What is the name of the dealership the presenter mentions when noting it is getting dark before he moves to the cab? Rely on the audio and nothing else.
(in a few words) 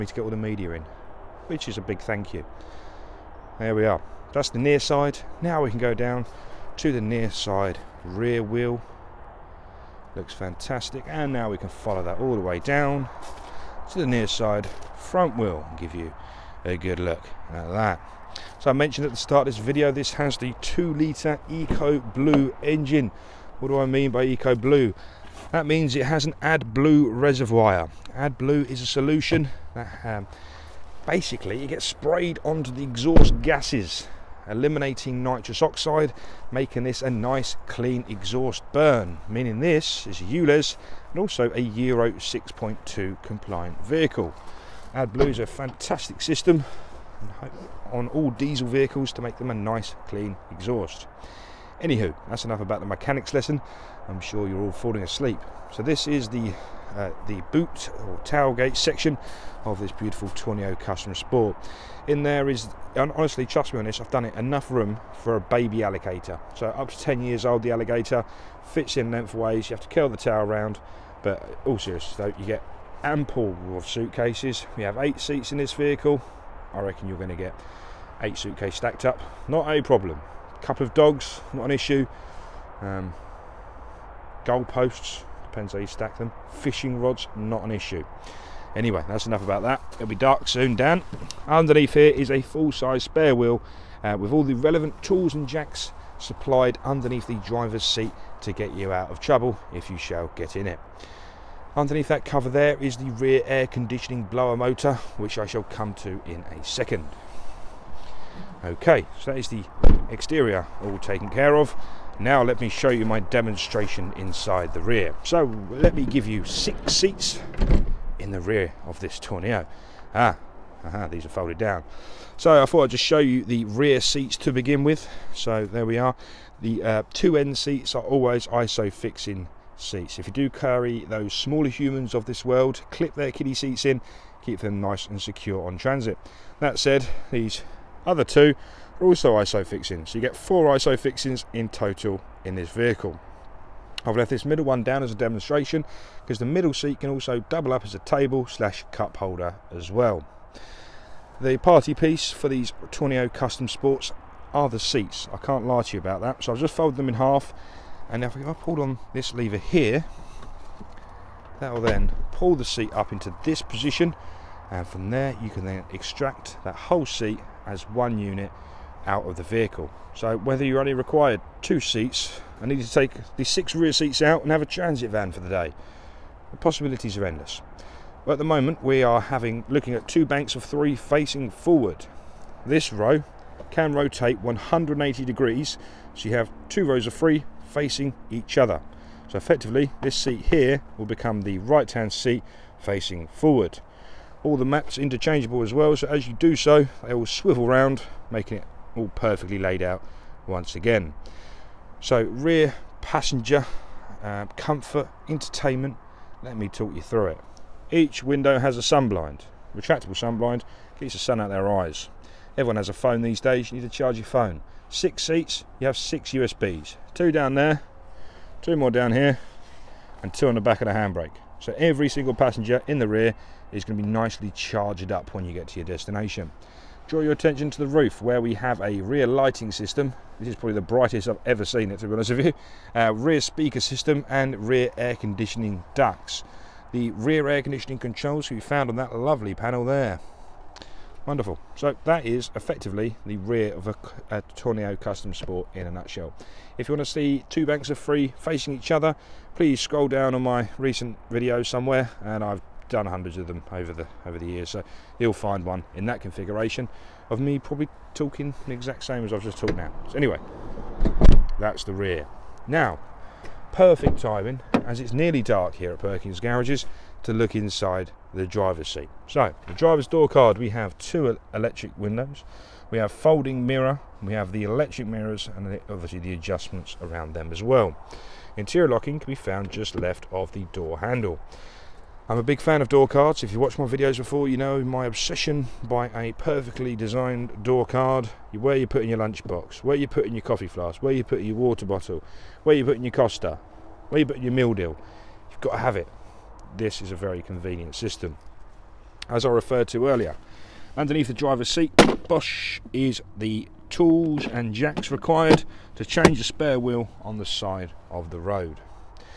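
Perkins Garages.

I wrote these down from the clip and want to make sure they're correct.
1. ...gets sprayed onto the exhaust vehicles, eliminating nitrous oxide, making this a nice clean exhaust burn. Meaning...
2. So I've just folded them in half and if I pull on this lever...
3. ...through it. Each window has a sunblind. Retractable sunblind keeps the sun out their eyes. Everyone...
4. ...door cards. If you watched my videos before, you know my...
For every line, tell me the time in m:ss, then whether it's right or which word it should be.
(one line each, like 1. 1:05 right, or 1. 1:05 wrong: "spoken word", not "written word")
1. 0:31 wrong: "gases", not "vehicles"
2. 2:36 right
3. 3:27 right
4. 4:42 right.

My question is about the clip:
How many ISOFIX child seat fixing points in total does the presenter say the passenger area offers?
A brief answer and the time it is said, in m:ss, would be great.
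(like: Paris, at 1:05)
4, at 2:20.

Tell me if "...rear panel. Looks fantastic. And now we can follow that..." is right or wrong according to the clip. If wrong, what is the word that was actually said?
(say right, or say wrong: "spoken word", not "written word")
wrong: "wheel", not "panel".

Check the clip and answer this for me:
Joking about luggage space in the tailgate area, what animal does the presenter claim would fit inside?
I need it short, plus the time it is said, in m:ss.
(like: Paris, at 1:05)
a baby alligator, at 1:05.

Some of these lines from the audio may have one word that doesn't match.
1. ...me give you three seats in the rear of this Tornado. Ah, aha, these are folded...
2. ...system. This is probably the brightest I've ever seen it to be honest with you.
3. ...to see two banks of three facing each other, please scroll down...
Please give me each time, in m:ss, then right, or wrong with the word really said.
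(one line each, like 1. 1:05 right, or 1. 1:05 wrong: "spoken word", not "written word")
1. 1:55 wrong: "six", not "three"
2. 3:49 right
3. 4:07 right.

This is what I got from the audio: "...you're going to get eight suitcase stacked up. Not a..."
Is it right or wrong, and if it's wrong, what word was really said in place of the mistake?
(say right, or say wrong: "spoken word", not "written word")
right.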